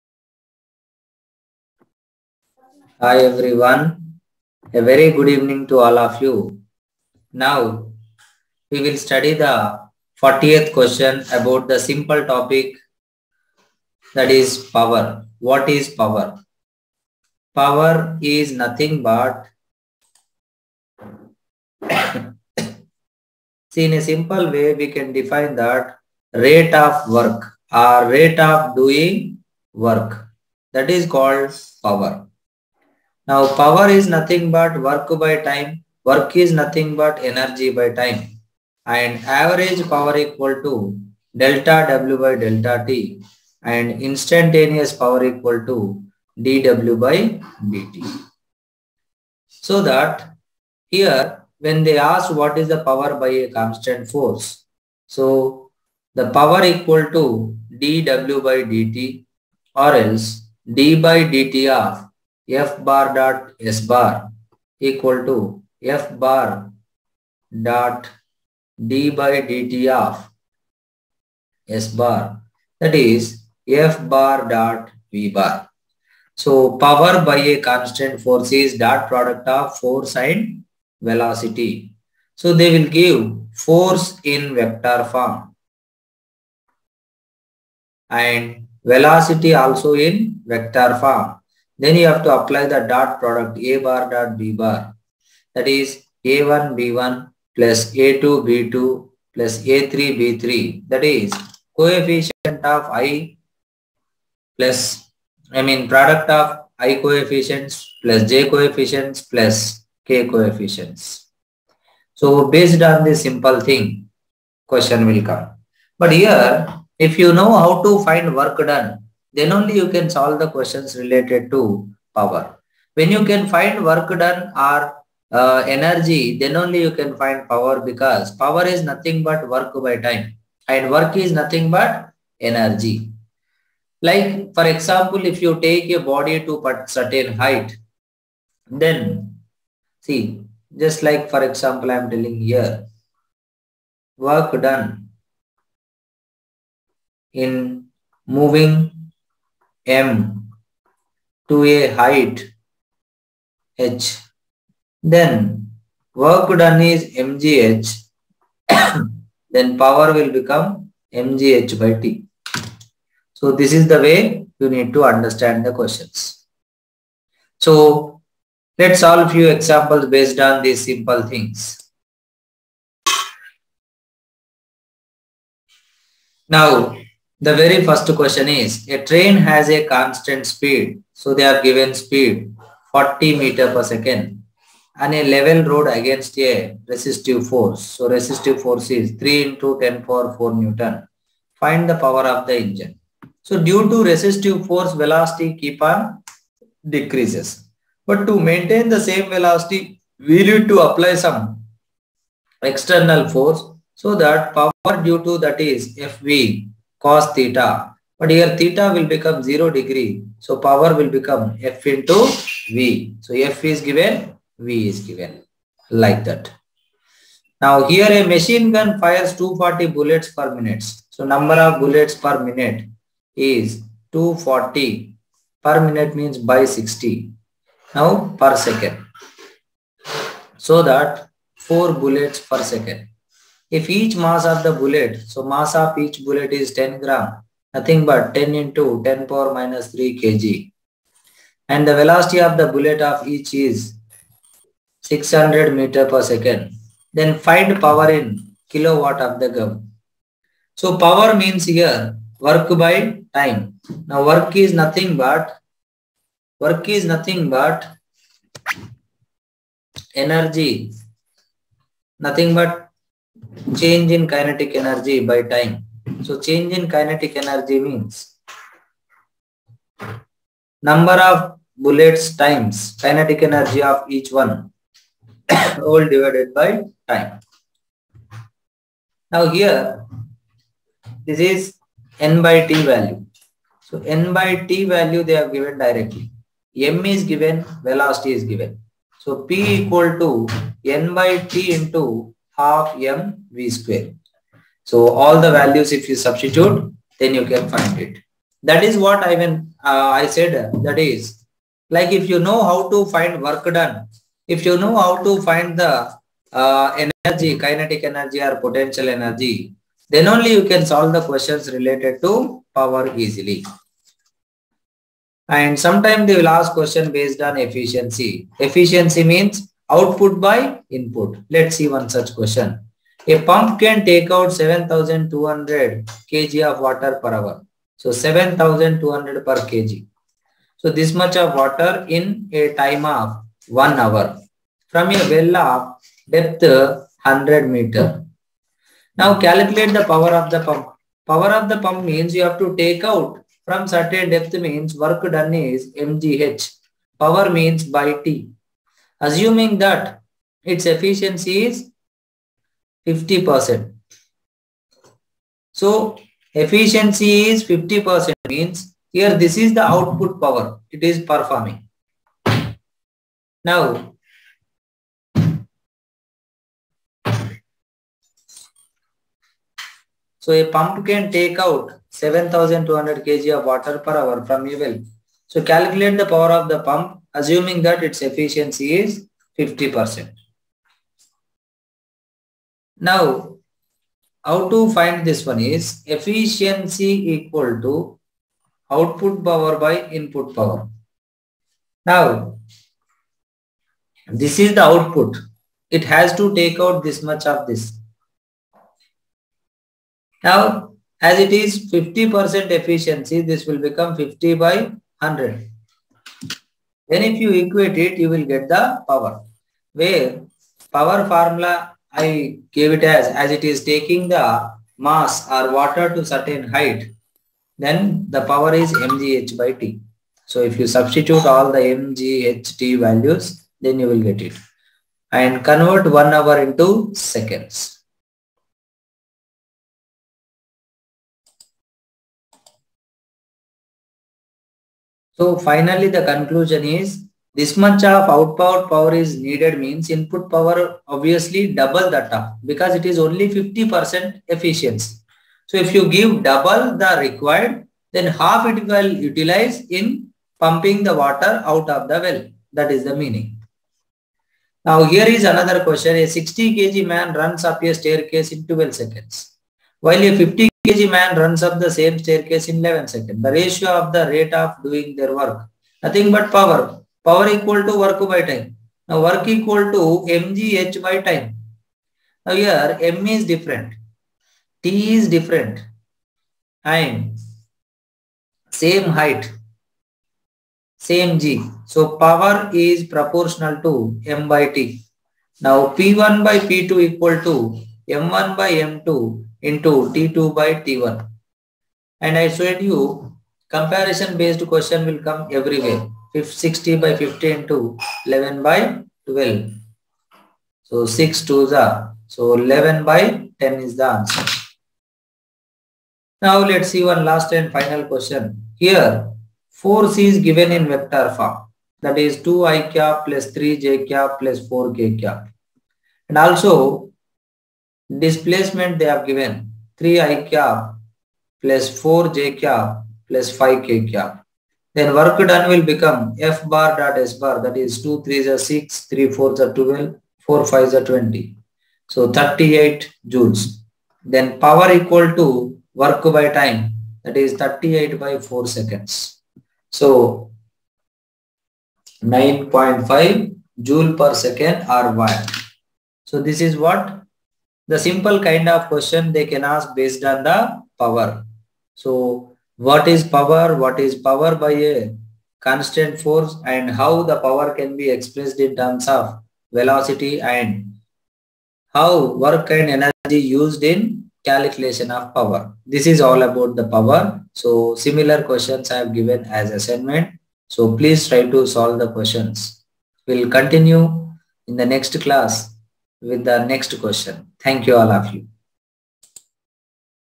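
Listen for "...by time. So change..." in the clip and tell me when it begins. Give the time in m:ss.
4:25.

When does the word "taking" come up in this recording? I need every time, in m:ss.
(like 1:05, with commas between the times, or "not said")
6:53.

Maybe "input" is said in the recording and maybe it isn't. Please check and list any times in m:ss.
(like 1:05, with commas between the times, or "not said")
5:20, 6:30, 7:20.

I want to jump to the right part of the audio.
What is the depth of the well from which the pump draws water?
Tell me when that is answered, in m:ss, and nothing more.
5:36.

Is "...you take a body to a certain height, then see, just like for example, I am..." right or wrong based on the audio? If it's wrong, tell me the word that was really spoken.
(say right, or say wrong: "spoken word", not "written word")
right.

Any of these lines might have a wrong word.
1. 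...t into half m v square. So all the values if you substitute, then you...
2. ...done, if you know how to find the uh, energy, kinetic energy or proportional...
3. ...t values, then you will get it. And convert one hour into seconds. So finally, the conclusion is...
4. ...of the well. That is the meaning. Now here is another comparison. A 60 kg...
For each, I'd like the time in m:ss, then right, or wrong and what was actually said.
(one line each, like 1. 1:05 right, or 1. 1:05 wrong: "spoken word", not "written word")
1. 4:51 right
2. 5:03 wrong: "potential", not "proportional"
3. 7:02 right
4. 7:31 wrong: "question", not "comparison".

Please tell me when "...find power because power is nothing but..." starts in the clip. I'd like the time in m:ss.
2:07.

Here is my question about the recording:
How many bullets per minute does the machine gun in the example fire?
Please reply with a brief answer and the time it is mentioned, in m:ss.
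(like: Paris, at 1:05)
240, at 3:39.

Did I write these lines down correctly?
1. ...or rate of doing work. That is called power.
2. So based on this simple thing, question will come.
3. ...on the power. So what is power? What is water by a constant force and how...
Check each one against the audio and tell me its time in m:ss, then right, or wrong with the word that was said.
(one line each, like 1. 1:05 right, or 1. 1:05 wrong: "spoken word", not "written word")
1. 0:27 right
2. 1:52 right
3. 9:10 wrong: "power", not "water".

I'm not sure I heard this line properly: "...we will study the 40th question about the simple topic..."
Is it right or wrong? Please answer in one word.
right.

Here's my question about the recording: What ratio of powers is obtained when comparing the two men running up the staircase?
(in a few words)
11/10.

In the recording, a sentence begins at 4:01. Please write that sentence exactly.
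And the velocity of the bullet of each is 600 meter per second.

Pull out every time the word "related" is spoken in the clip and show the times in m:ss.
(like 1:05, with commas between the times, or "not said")
2:00, 5:11.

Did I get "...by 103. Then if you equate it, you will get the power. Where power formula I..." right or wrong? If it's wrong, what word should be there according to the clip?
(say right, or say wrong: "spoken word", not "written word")
wrong: "100", not "103".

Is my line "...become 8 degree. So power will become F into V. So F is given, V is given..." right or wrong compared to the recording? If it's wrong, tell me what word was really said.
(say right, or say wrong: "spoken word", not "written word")
wrong: "0", not "8".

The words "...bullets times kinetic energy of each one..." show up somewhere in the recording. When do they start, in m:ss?
4:31.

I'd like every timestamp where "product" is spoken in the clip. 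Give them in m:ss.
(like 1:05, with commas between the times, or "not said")
1:19, 1:33, 1:45.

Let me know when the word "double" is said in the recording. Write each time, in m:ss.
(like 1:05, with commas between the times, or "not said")
7:21, 7:26.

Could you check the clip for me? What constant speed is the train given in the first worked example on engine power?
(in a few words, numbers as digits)
40 m/s.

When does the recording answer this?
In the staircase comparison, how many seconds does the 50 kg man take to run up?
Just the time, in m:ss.
7:42.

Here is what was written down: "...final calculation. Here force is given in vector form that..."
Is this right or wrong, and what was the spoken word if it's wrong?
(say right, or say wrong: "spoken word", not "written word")
wrong: "question", not "calculation".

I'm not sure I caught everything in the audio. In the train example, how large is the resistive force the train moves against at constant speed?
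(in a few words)
3 × 10^4 N.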